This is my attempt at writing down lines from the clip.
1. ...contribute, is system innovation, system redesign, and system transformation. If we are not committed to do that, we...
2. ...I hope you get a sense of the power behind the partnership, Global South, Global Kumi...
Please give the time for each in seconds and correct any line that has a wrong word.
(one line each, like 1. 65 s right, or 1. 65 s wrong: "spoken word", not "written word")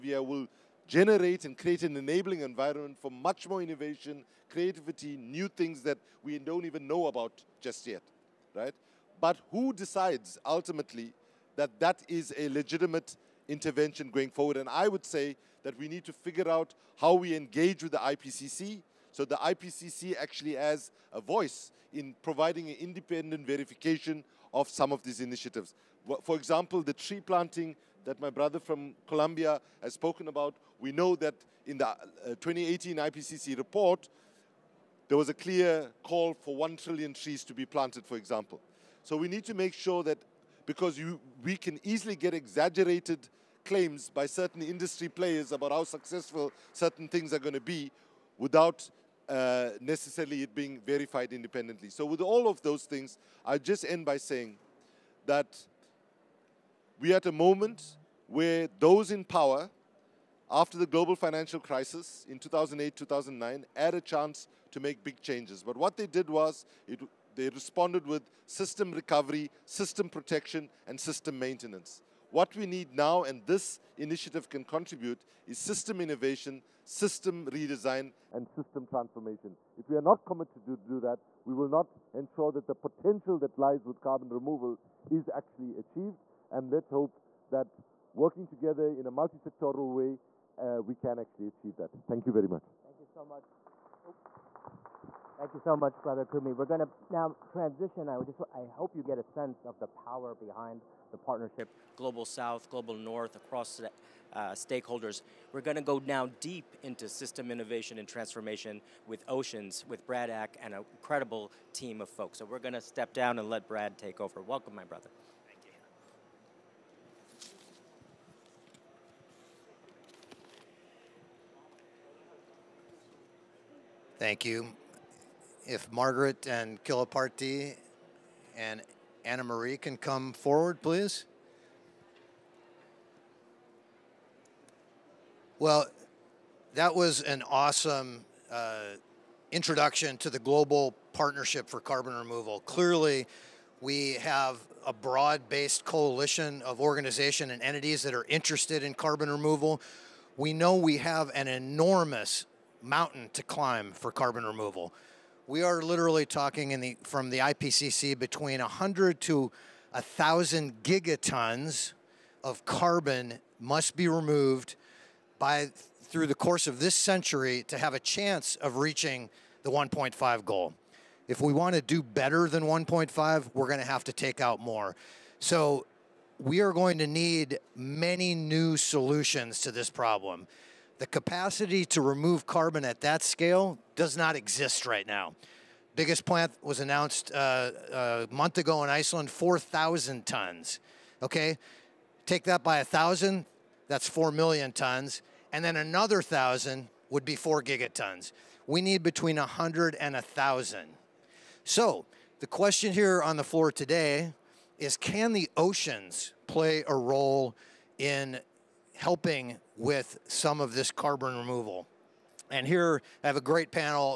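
1. 74 s right
2. 98 s wrong: "North", not "Kumi".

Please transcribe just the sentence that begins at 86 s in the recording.
And let's hope that working together in a multi-sectoral way, uh, we can actually achieve that.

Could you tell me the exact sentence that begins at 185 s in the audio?
Biggest plant was announced uh, a uh, month ago in Iceland, 4,000 tons.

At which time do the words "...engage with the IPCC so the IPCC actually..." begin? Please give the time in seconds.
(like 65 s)
17 s.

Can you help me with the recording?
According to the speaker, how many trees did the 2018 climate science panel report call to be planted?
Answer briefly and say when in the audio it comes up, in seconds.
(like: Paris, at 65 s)
1 trillion, at 36 s.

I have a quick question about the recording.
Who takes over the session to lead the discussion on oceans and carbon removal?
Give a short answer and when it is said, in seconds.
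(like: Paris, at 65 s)
Brad Ack, at 110 s.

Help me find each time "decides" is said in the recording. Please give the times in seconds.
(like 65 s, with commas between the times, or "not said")
9 s.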